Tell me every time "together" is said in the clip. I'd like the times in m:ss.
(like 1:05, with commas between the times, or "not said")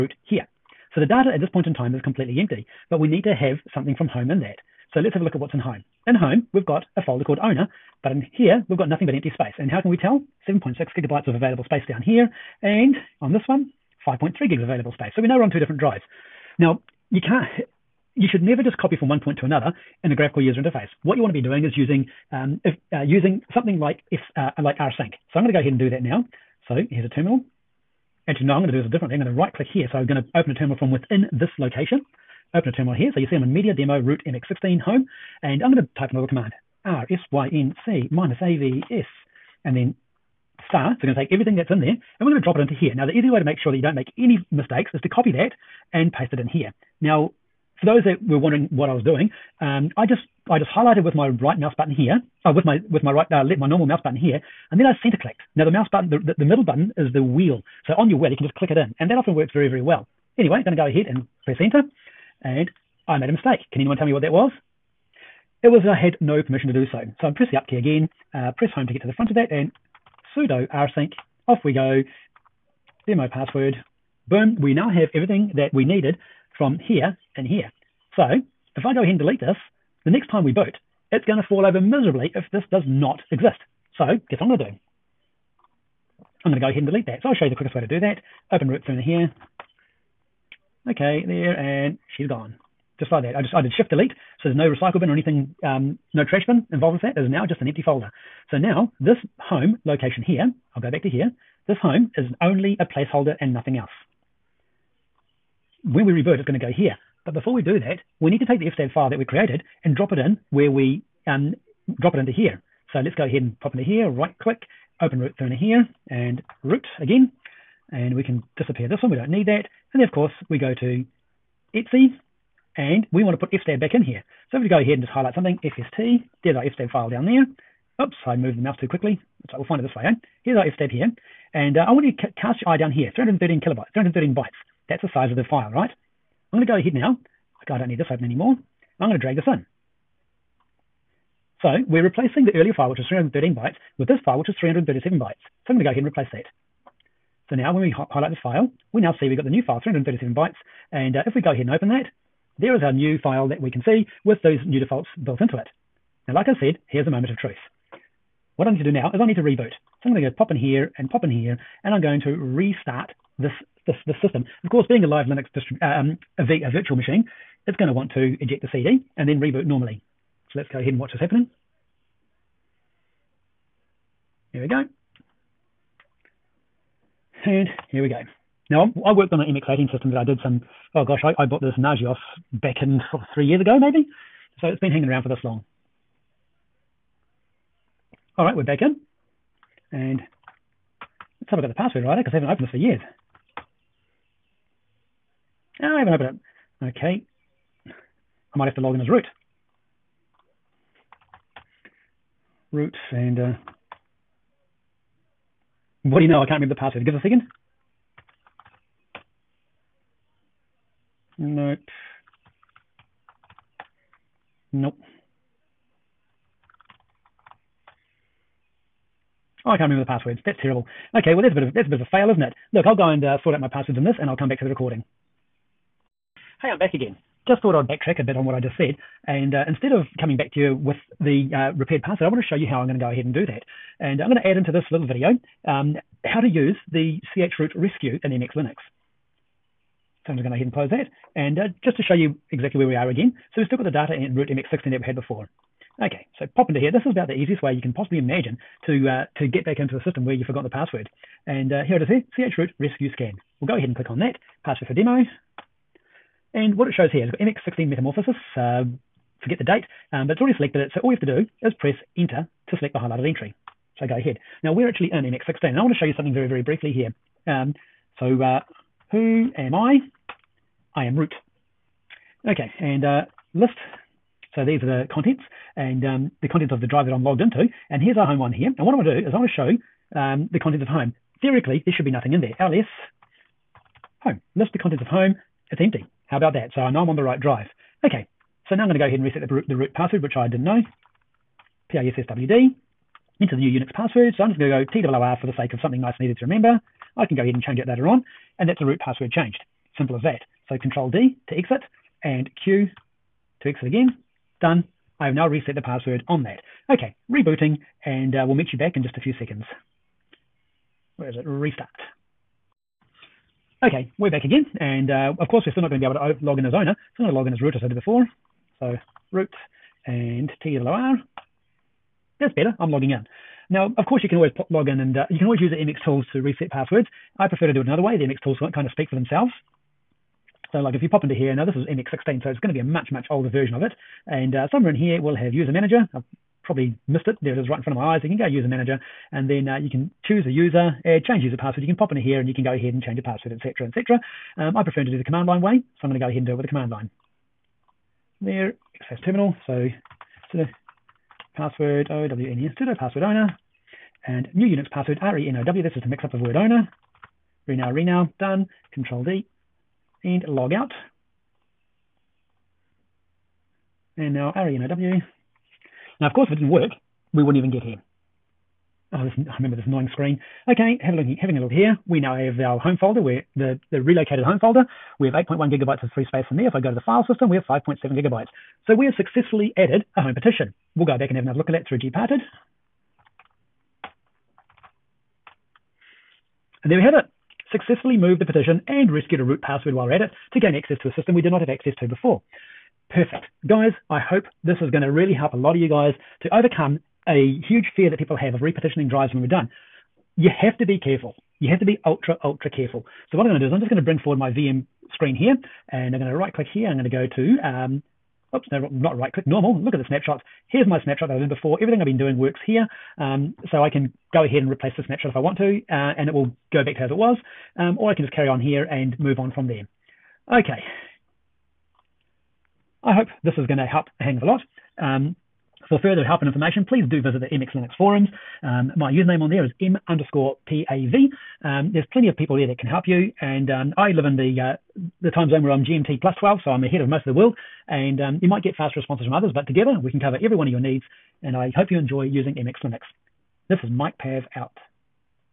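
7:19.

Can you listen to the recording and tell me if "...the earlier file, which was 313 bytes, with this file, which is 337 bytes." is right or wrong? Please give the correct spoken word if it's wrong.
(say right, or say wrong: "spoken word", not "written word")
right.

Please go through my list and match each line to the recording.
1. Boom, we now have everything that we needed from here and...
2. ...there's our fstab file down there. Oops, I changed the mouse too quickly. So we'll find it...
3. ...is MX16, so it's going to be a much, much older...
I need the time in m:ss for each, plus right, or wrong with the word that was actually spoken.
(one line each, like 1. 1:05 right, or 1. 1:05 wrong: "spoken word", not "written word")
1. 1:14 right
2. 2:06 wrong: "moved", not "changed"
3. 5:31 right.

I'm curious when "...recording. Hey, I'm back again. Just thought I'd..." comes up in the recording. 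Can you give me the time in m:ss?
3:44.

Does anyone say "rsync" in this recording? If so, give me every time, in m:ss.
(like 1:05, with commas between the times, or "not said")
0:24, 0:36, 1:10.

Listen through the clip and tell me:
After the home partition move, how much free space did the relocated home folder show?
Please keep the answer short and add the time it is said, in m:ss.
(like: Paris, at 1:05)
8.1 gigabytes, at 6:15.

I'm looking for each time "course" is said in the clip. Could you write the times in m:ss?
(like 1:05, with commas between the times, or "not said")
2:00, 2:44, 5:15, 5:24, 6:06.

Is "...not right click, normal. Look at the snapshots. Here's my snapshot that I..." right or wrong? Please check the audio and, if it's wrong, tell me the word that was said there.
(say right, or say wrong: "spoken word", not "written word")
right.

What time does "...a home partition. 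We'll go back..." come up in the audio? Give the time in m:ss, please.
6:20.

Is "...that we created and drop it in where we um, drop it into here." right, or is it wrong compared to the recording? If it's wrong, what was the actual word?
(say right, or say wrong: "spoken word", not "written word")
right.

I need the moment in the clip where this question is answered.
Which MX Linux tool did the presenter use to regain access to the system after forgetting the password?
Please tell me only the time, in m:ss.
4:12.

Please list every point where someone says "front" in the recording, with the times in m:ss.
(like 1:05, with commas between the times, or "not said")
1:09, 5:37.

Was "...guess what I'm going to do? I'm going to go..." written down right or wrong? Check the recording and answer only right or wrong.
right.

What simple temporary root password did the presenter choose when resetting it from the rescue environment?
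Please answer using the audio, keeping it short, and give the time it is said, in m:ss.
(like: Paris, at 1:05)
TWR, at 4:55.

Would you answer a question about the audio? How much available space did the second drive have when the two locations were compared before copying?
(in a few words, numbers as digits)
5.3 gigabytes.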